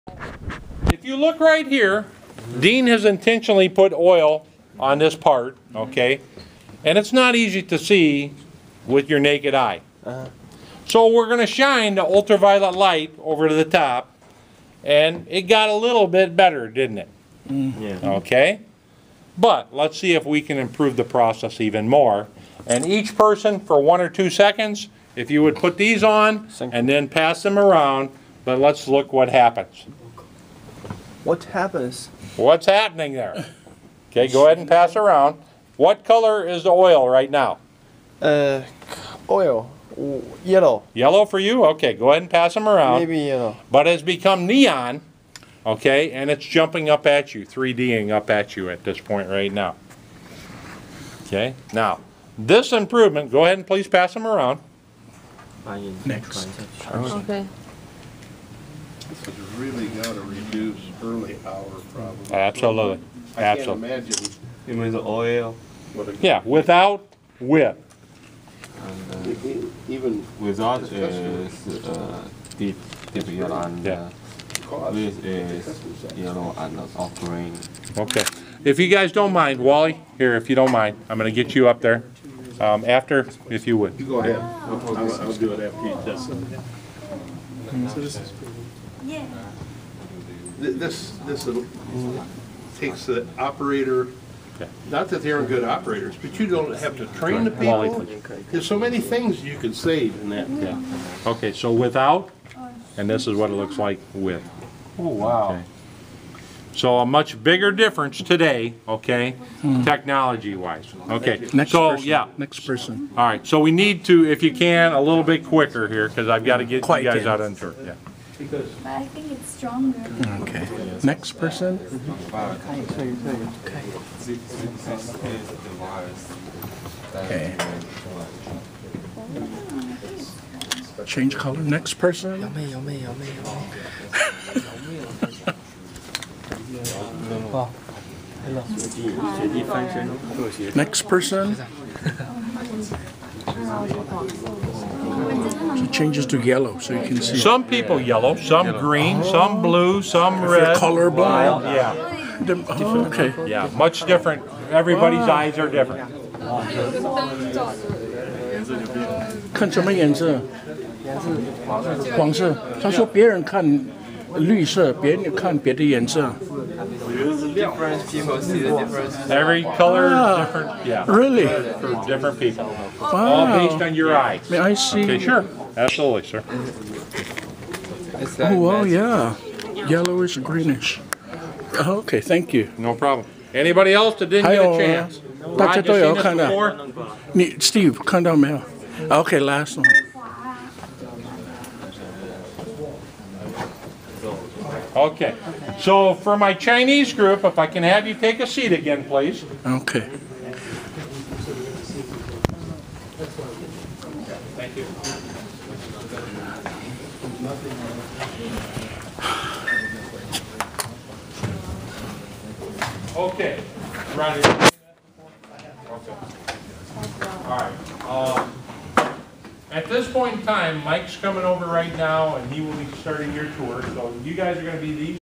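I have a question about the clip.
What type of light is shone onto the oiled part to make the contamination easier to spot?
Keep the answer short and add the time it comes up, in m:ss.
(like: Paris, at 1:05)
Ultraviolet light, at 0:12.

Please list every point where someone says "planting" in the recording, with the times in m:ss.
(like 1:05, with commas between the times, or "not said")
not said.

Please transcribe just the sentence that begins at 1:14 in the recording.
uh, with is yellow and uh, off green.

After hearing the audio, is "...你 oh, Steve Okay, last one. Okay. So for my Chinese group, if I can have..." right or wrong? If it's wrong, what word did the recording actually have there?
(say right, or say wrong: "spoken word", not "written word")
right.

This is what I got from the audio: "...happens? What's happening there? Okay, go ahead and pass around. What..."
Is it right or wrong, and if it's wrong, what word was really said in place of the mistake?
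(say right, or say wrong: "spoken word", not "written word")
right.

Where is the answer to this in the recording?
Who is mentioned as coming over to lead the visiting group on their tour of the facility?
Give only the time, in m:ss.
3:40.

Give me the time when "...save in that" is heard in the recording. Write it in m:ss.
1:39.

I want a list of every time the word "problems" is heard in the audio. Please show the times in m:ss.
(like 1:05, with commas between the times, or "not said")
1:01, 3:02.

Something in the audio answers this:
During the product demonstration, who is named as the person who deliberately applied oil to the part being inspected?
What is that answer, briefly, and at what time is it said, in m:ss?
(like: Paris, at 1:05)
Dean, at 0:02.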